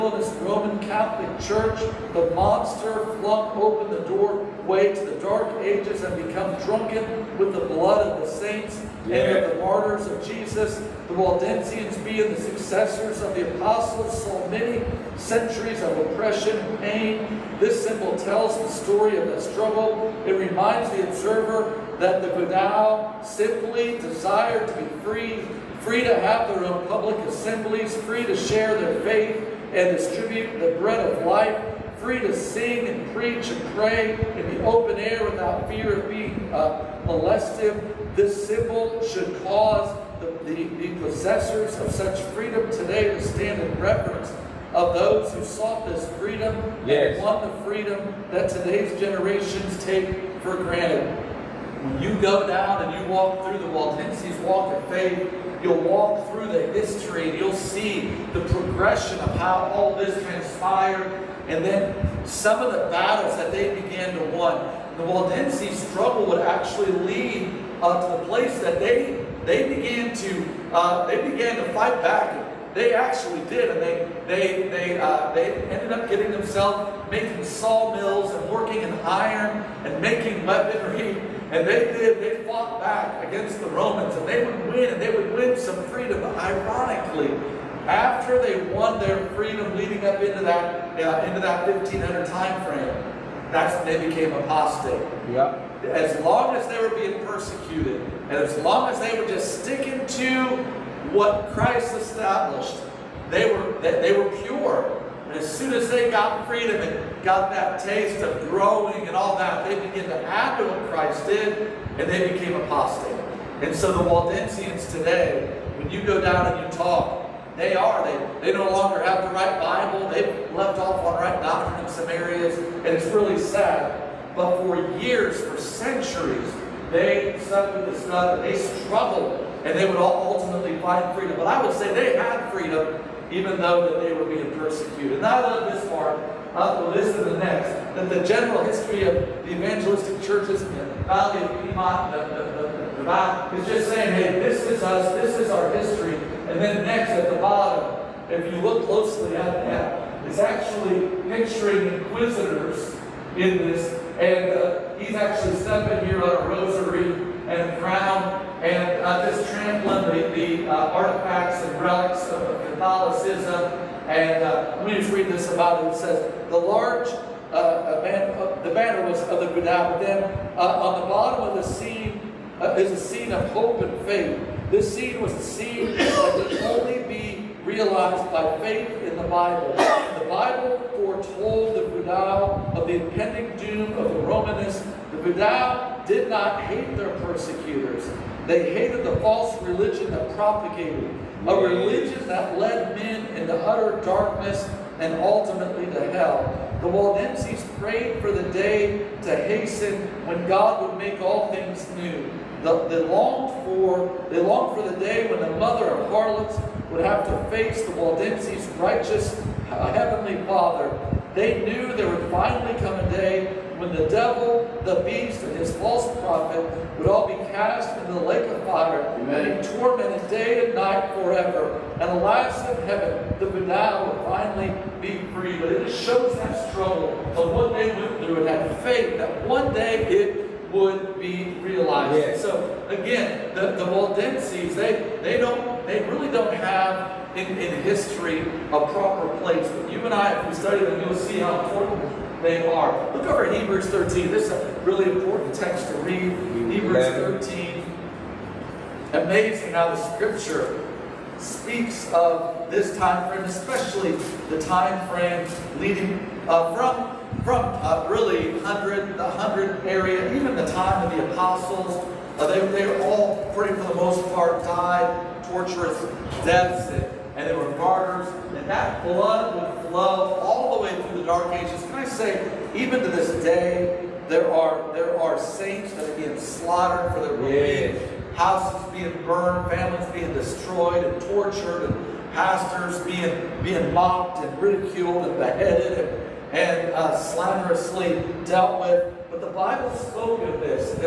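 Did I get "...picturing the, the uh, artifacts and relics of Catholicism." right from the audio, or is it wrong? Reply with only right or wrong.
wrong.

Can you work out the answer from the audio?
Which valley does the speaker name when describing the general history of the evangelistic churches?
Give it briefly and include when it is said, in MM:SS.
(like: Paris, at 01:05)
Valley of Piedmont, at 02:21.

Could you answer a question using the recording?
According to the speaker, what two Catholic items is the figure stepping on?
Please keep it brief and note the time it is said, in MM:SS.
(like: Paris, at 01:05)
rosary and crown, at 02:36.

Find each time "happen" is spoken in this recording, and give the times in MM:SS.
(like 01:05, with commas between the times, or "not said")
01:50.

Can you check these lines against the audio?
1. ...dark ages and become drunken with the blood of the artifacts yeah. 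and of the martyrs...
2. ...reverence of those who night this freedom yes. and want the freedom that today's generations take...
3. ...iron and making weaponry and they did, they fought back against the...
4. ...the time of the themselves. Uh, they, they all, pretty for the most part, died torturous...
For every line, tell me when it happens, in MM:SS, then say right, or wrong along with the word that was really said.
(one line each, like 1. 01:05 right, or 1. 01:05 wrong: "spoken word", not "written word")
1. 00:05 wrong: "saints", not "artifacts"
2. 00:43 wrong: "sought", not "night"
3. 01:19 right
4. 04:20 wrong: "apostles", not "themselves".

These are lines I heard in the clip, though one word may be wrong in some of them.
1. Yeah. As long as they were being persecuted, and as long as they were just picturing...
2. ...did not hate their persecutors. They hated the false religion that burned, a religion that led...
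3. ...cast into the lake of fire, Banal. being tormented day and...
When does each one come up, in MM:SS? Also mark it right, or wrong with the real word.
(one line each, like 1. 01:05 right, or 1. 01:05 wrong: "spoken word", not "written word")
1. 01:35 wrong: "sticking", not "picturing"
2. 03:06 wrong: "propagated", not "burned"
3. 03:37 wrong: "Amen", not "Banal".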